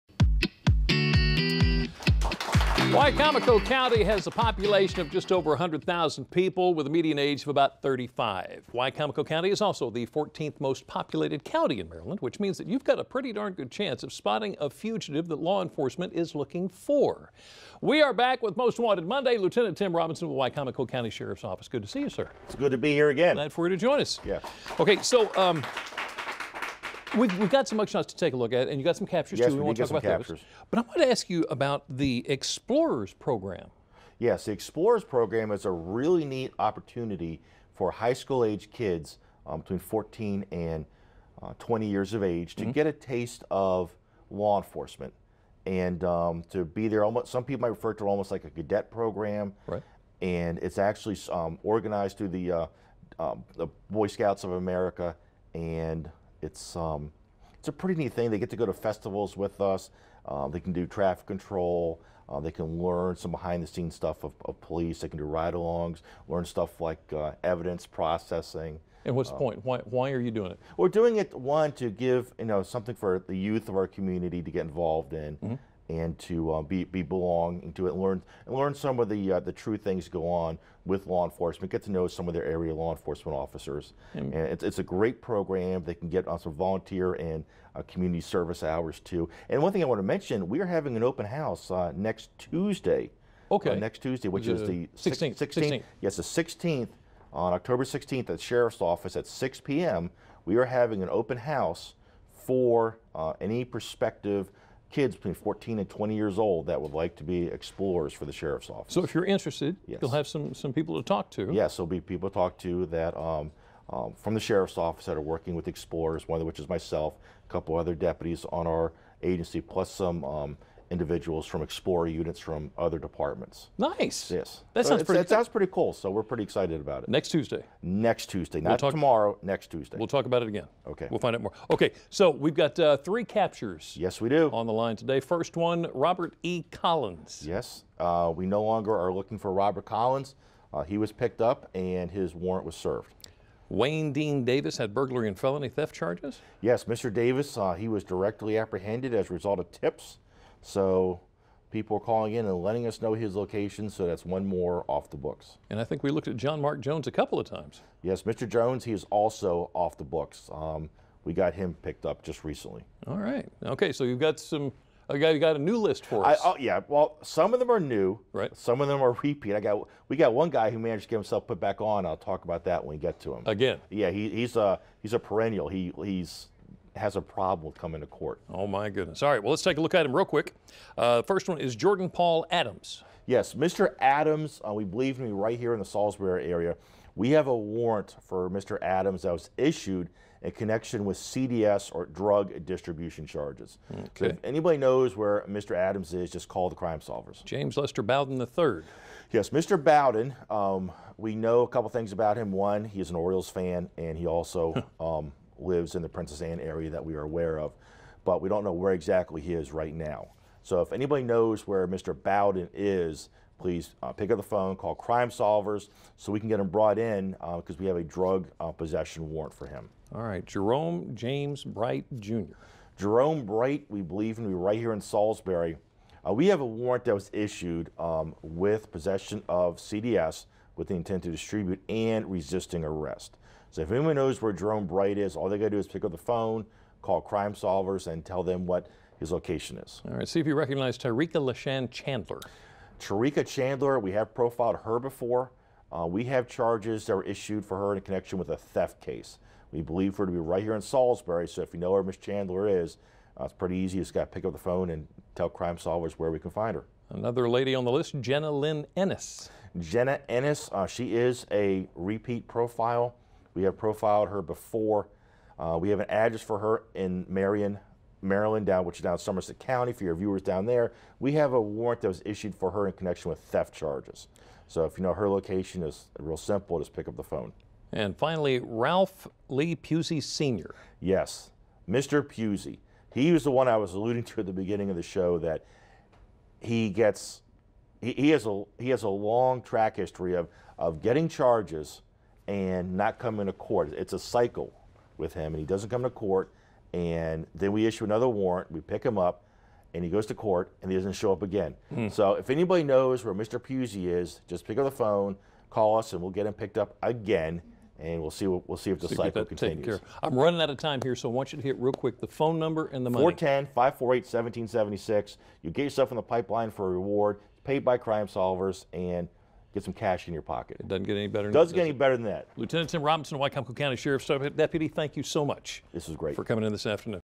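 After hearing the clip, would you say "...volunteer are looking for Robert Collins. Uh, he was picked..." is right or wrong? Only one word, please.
wrong.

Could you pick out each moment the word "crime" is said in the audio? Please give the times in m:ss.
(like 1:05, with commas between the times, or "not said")
3:16, 3:34, 3:57, 4:15, 5:17.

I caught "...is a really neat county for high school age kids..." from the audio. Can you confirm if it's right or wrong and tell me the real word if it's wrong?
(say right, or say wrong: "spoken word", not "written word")
wrong: "opportunity", not "county".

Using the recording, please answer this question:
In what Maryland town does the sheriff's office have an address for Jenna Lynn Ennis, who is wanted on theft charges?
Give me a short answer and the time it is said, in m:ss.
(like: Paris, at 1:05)
Marion, at 4:27.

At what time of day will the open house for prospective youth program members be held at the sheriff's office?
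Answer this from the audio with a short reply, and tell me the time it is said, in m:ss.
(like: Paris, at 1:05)
6 p.m., at 1:39.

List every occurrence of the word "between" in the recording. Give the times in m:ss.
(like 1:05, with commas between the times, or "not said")
0:39, 1:45.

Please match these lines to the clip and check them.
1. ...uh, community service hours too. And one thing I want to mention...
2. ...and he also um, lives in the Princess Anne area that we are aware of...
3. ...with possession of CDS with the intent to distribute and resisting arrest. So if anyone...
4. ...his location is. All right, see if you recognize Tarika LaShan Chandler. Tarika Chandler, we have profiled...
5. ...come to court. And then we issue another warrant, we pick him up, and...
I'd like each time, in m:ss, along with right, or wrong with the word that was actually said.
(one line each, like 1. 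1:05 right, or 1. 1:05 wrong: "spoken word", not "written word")
1. 1:27 right
2. 3:23 right
3. 3:48 right
4. 3:59 right
5. 4:55 right.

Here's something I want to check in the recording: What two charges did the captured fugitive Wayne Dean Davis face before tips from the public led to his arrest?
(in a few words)
Burglary and felony theft.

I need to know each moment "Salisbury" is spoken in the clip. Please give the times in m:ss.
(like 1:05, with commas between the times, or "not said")
3:05, 3:45, 4:10.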